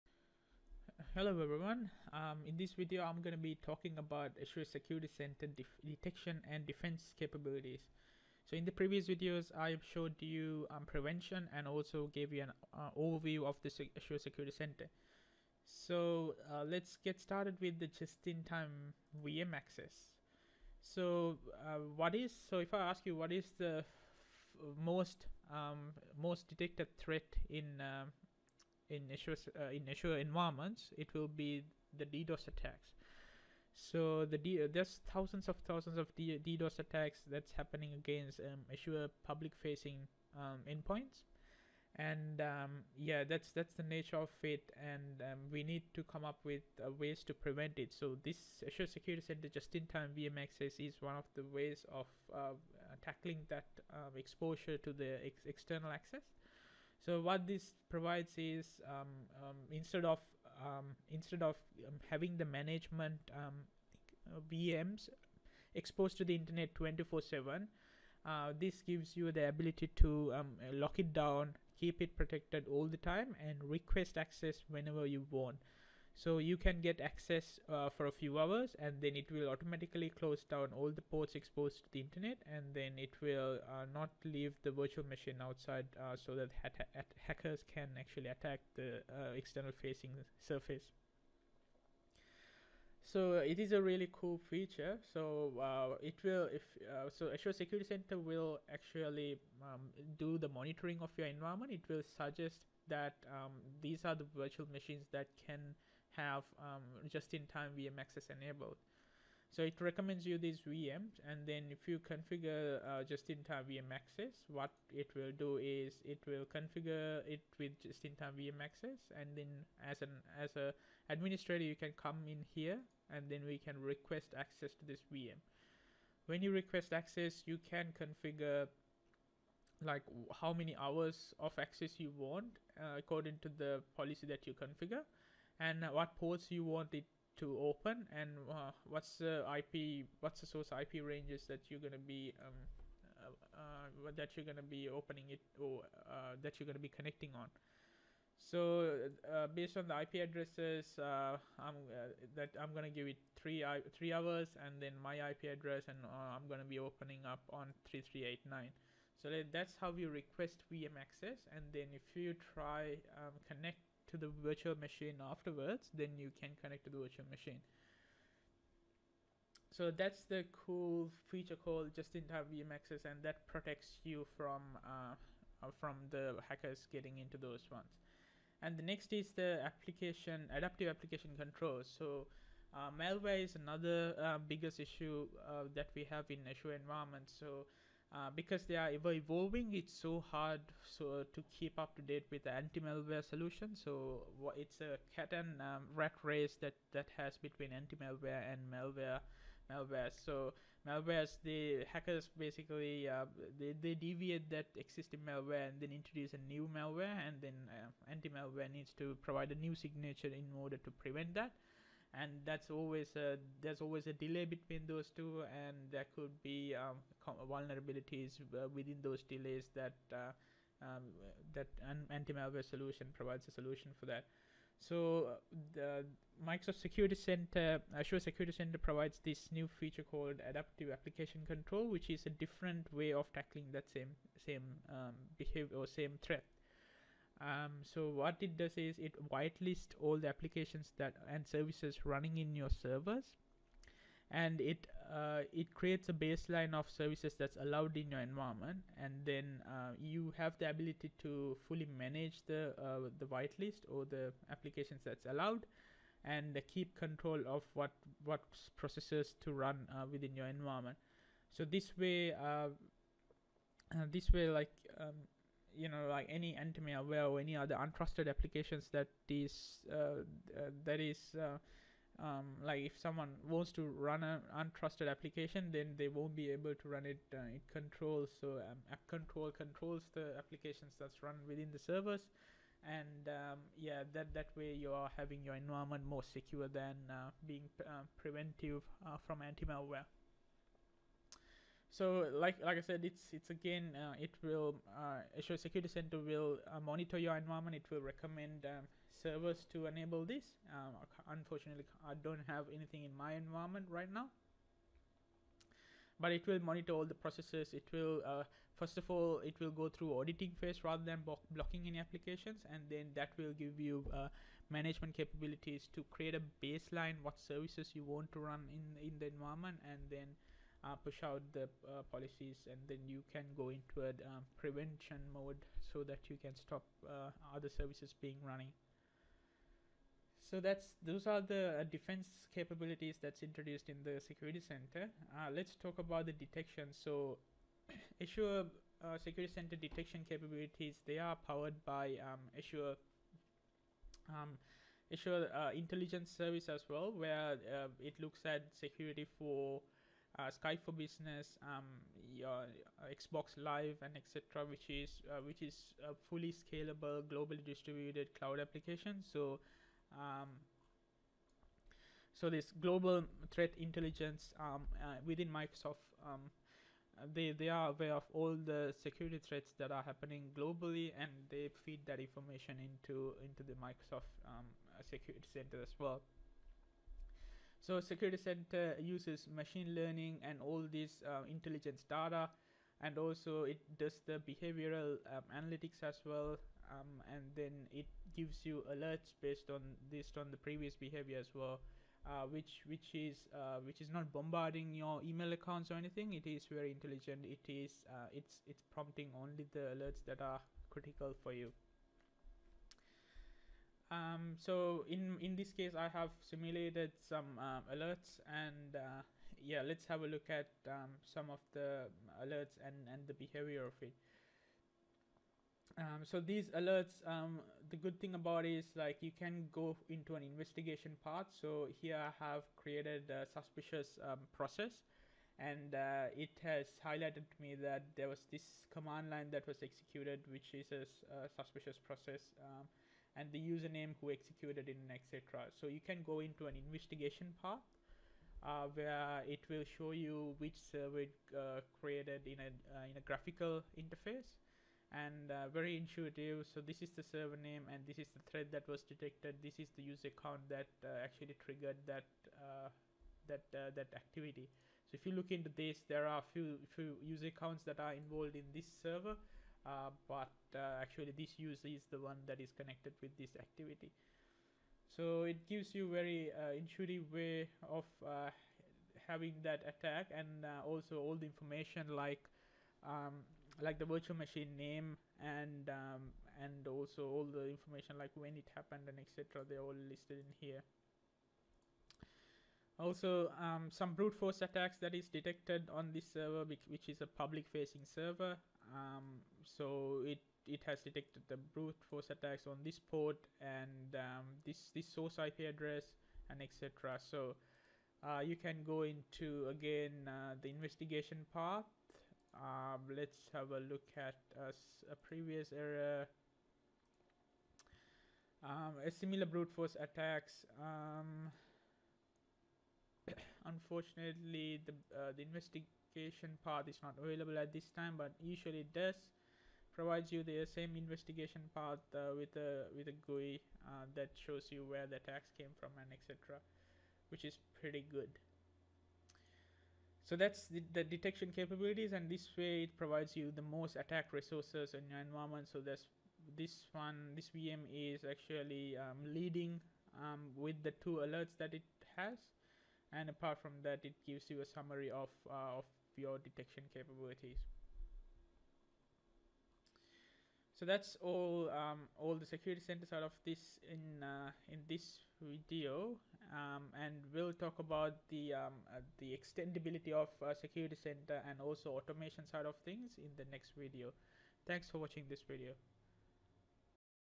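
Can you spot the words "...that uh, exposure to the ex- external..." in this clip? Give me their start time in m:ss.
0:53.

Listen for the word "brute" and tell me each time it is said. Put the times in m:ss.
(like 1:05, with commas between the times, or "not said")
8:04, 8:11, 8:29.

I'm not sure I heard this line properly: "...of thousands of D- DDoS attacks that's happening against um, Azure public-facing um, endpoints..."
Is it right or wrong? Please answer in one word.
right.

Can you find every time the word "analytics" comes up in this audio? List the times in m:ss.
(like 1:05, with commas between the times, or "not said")
6:25.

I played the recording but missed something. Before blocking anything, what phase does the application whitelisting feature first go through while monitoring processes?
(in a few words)
auditing phase.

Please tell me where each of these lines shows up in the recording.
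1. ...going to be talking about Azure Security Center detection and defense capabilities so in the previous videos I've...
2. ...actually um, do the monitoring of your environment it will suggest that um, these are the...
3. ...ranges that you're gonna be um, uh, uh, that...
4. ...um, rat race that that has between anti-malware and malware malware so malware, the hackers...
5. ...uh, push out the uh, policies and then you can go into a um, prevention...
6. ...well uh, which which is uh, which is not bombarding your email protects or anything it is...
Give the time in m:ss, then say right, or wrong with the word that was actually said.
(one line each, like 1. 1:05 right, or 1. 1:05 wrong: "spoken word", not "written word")
1. 0:03 right
2. 1:38 right
3. 2:21 right
4. 3:15 right
5. 5:20 right
6. 6:31 wrong: "accounts", not "protects".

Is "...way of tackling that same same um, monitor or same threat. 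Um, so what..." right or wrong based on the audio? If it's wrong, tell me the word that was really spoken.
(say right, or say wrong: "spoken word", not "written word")
wrong: "behavior", not "monitor".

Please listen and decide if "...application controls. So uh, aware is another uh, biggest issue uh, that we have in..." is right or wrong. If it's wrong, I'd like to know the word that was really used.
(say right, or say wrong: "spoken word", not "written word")
wrong: "malware", not "aware".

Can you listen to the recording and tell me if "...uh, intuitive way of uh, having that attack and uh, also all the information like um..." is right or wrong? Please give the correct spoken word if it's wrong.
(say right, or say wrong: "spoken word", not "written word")
right.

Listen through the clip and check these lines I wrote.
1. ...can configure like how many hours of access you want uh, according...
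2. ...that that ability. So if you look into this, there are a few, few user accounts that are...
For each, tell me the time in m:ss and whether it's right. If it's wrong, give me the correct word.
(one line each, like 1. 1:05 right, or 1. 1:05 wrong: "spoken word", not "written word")
1. 2:07 right
2. 7:33 wrong: "activity", not "ability".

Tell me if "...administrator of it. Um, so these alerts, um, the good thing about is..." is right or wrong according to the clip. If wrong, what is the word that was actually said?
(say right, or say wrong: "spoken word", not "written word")
wrong: "behavior", not "administrator".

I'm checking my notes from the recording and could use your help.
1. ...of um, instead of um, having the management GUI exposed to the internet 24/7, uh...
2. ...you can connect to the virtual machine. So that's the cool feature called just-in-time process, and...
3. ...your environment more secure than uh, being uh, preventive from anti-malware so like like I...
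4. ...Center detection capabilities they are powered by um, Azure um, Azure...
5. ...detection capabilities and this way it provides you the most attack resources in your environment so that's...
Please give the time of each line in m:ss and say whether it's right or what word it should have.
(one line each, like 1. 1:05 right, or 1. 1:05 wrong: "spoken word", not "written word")
1. 1:00 wrong: "VMs", not "GUI"
2. 2:46 wrong: "access", not "process"
3. 4:45 right
4. 5:39 right
5. 8:51 right.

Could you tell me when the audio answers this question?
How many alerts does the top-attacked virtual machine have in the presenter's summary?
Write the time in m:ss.
9:01.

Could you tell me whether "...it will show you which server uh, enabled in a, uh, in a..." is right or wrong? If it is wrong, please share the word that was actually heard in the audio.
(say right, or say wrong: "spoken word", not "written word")
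wrong: "created", not "enabled".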